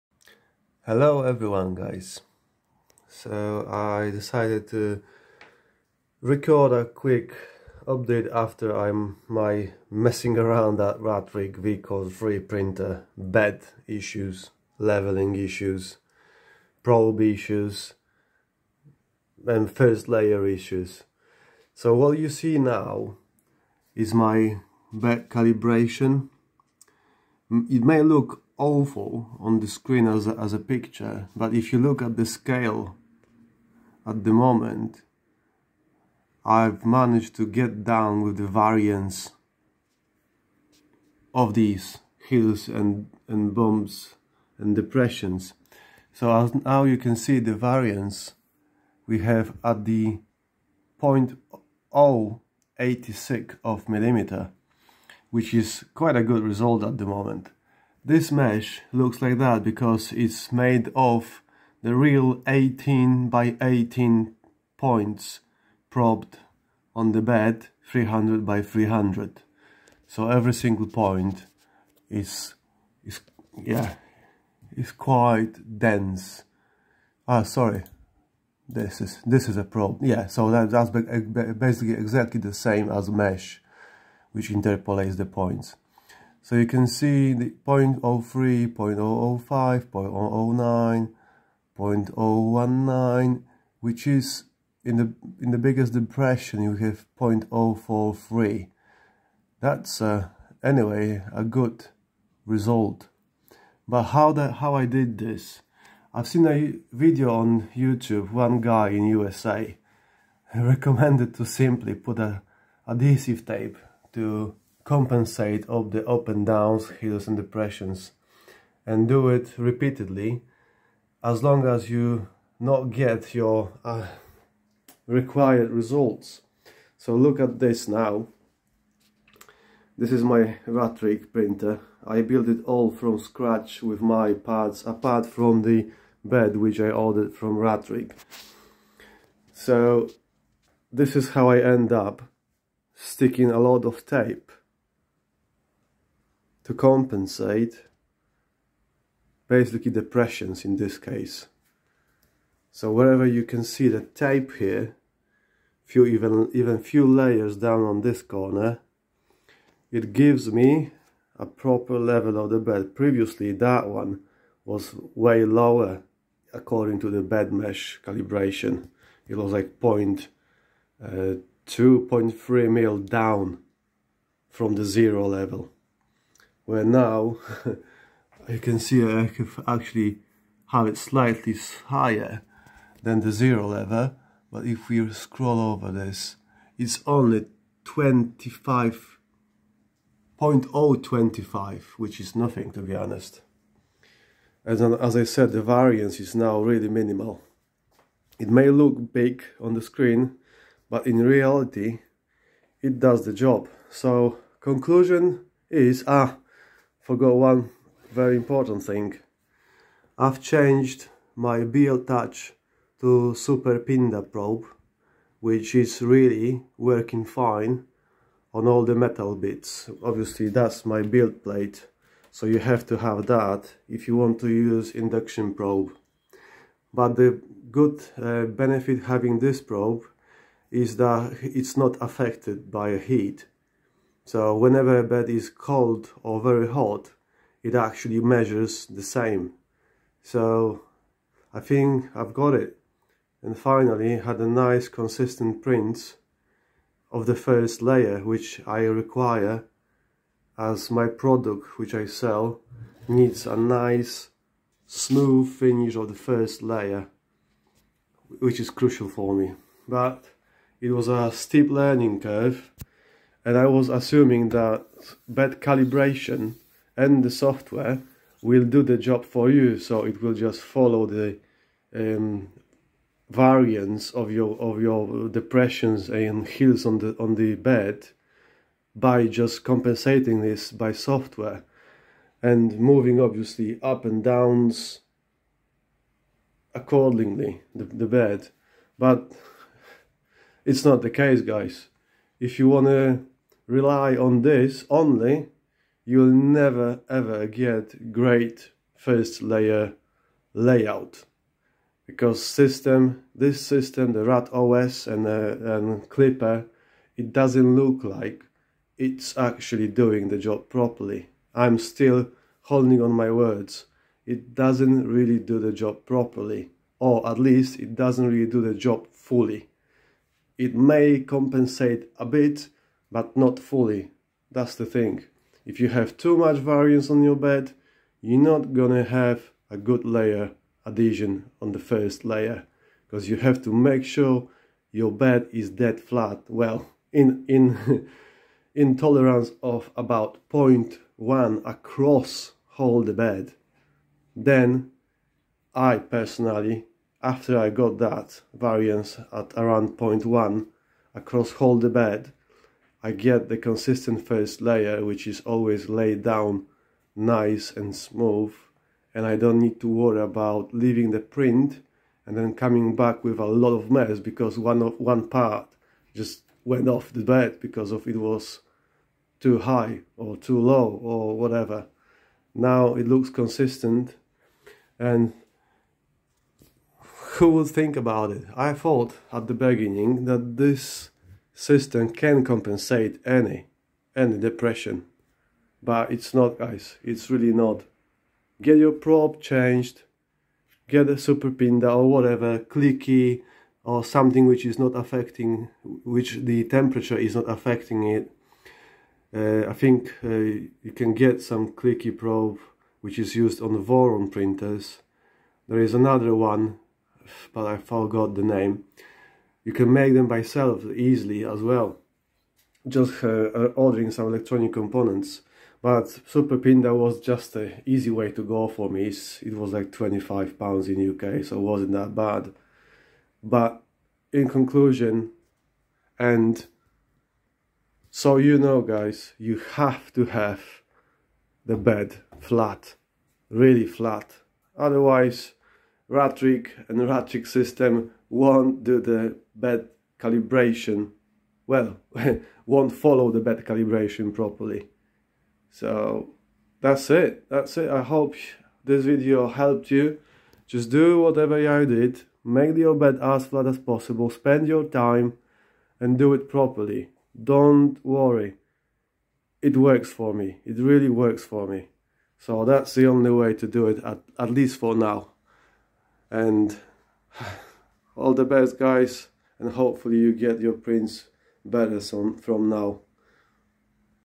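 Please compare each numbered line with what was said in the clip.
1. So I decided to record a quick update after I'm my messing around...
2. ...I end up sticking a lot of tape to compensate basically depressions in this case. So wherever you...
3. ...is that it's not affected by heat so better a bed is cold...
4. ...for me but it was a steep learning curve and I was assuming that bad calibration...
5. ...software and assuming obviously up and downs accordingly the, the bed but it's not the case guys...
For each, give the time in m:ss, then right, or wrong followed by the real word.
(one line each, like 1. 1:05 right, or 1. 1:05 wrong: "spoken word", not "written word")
1. 0:03 right
2. 2:21 right
3. 3:50 wrong: "whenever", not "better"
4. 4:19 right
5. 4:40 wrong: "moving", not "assuming".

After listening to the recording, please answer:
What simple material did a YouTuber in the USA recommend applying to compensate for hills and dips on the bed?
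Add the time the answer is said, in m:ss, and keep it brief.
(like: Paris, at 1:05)
Adhesive tape, at 1:52.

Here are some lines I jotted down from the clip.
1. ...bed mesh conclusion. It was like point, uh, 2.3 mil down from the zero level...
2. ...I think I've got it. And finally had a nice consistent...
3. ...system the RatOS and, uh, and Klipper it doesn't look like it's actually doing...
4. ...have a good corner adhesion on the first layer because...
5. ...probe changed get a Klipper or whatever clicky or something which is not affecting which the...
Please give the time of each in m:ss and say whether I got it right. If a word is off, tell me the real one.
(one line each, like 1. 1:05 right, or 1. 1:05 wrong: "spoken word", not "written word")
1. 2:47 wrong: "calibration", not "conclusion"
2. 4:01 right
3. 5:03 right
4. 5:29 wrong: "layer", not "corner"
5. 6:28 wrong: "SuperPINDA", not "Klipper".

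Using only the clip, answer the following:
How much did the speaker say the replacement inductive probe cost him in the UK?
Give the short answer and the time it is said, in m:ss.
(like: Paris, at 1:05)
25 pounds, at 6:59.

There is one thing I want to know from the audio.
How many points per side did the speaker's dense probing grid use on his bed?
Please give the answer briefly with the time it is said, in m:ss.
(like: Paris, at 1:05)
18 by 18, at 1:02.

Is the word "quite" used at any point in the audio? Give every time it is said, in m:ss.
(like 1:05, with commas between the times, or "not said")
0:55, 1:14.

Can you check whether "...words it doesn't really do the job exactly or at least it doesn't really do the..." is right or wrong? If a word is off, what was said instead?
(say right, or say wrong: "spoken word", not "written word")
wrong: "properly", not "exactly".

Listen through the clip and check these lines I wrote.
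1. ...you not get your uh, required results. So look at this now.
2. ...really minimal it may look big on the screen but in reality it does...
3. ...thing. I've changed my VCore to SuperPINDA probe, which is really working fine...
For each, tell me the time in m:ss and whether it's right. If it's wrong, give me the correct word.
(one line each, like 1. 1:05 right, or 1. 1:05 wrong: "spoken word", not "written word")
1. 2:01 right
2. 3:16 right
3. 3:28 wrong: "BLTouch", not "VCore".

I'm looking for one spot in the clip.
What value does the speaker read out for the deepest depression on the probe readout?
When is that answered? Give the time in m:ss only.
1:37.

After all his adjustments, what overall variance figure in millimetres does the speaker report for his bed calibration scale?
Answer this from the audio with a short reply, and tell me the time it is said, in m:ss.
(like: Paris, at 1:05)
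0.086, at 0:51.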